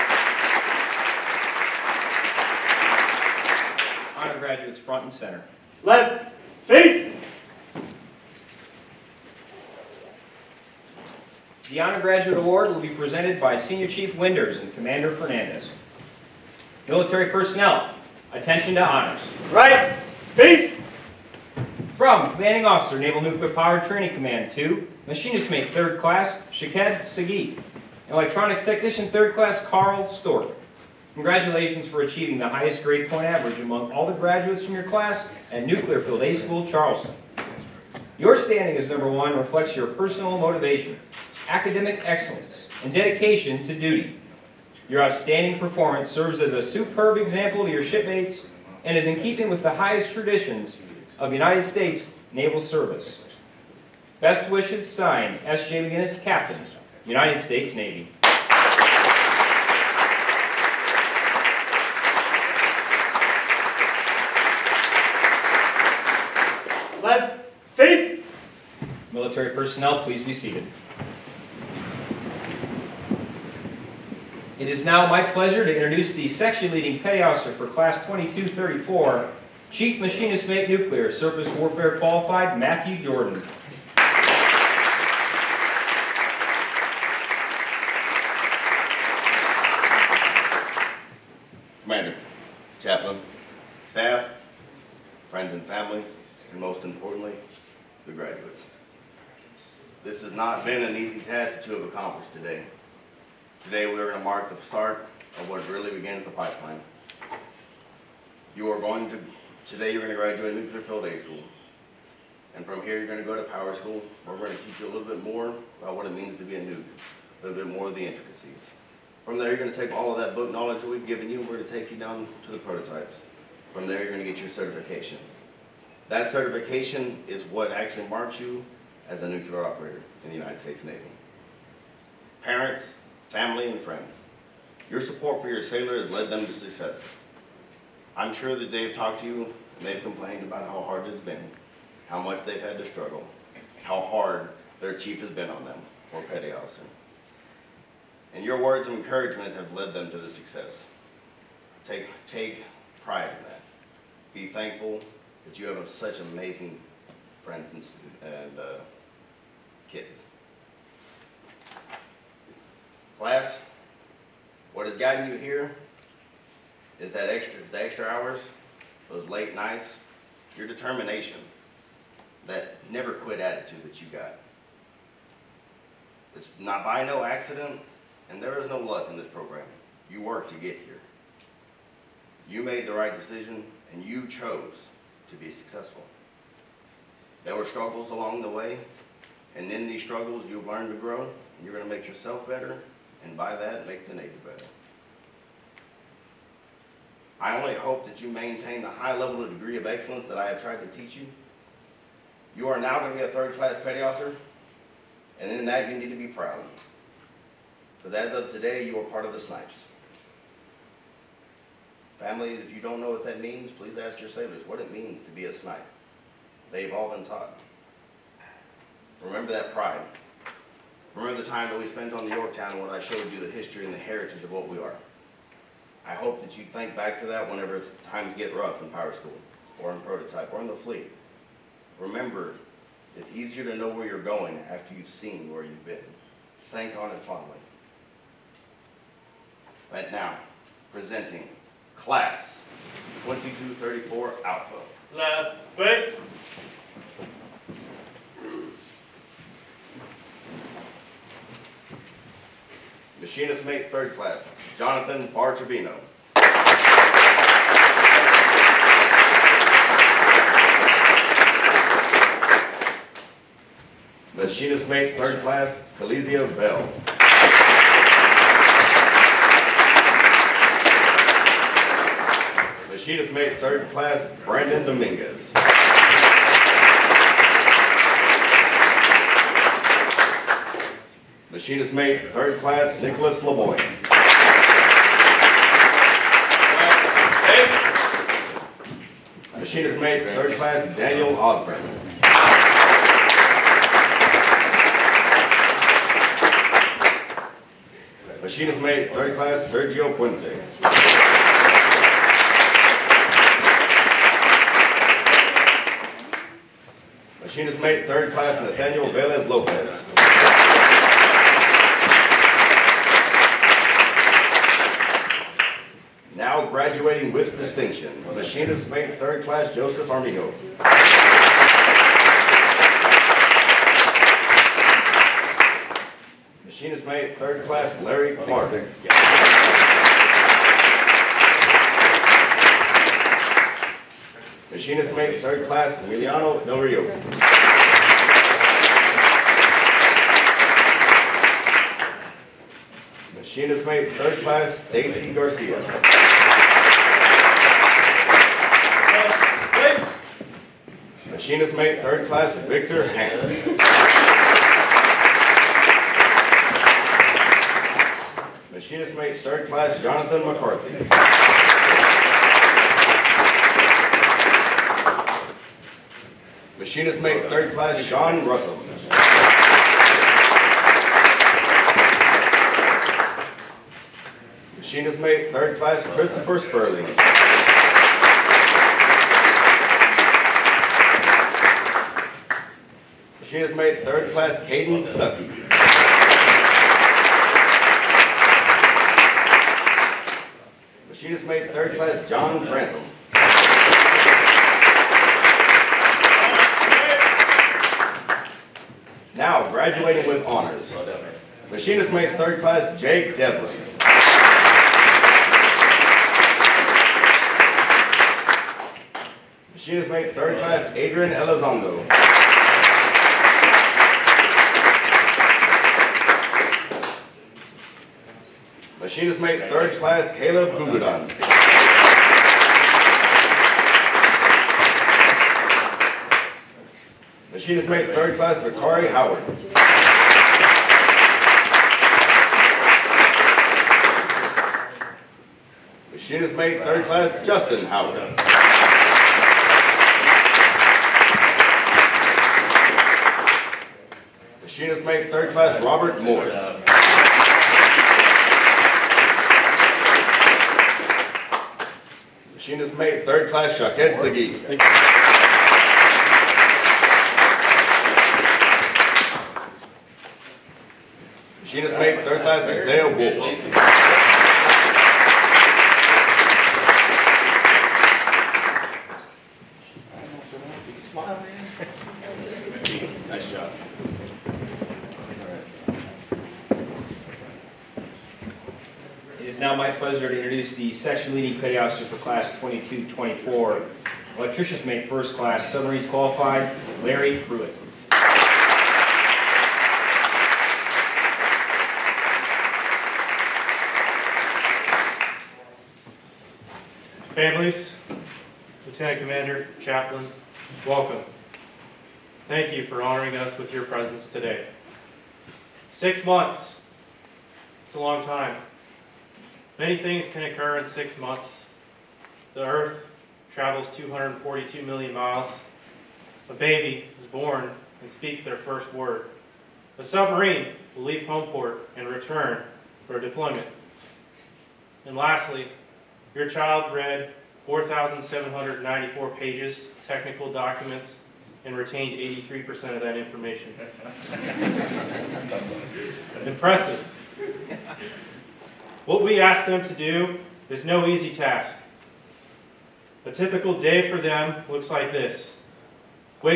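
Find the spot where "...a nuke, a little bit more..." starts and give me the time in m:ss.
1:56.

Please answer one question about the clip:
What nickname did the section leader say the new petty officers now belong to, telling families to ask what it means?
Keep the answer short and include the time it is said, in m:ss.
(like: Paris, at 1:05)
snipes, at 3:29.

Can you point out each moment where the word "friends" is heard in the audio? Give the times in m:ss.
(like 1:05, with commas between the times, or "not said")
2:13, 2:37.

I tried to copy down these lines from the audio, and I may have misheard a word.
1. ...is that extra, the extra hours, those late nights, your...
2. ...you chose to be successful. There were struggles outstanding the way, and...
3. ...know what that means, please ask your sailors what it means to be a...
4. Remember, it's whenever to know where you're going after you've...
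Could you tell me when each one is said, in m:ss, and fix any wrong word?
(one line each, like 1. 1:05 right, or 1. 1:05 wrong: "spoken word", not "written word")
1. 2:47 right
2. 3:04 wrong: "along", not "outstanding"
3. 3:33 right
4. 3:51 wrong: "easier", not "whenever".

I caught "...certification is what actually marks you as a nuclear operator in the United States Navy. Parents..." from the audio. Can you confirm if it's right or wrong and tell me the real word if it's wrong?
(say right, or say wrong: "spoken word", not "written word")
right.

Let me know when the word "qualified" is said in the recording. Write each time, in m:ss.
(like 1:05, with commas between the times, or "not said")
1:21, 8:06.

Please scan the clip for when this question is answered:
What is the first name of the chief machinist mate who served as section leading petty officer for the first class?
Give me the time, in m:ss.
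1:22.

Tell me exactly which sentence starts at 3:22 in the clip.
You are now going to be a third-class petty officer, and in that, you need to be proud.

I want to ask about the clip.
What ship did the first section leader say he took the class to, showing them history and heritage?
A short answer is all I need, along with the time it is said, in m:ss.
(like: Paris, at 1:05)
Yorktown, at 3:42.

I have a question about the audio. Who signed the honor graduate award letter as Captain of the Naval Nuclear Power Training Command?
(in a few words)
S.J. McGinnis.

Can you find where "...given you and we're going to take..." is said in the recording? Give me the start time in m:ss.
2:01.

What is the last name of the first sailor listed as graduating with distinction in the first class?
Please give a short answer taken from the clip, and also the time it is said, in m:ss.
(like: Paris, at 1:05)
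Armijo, at 5:20.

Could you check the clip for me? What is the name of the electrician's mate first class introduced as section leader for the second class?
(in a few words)
Larry Pruitt.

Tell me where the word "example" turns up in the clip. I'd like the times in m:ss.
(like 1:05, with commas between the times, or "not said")
0:47.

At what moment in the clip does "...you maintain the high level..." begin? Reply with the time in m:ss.
3:18.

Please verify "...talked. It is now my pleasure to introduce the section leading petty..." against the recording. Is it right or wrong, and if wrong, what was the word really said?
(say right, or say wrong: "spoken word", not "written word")
wrong: "seated", not "talked".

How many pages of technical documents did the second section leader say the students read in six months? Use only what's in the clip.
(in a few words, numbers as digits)
4,794.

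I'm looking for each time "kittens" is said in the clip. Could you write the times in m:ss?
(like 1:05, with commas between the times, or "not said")
2:39.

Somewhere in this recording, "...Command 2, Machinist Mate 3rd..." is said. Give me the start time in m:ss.
0:24.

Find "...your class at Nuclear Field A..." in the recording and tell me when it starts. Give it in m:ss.
0:34.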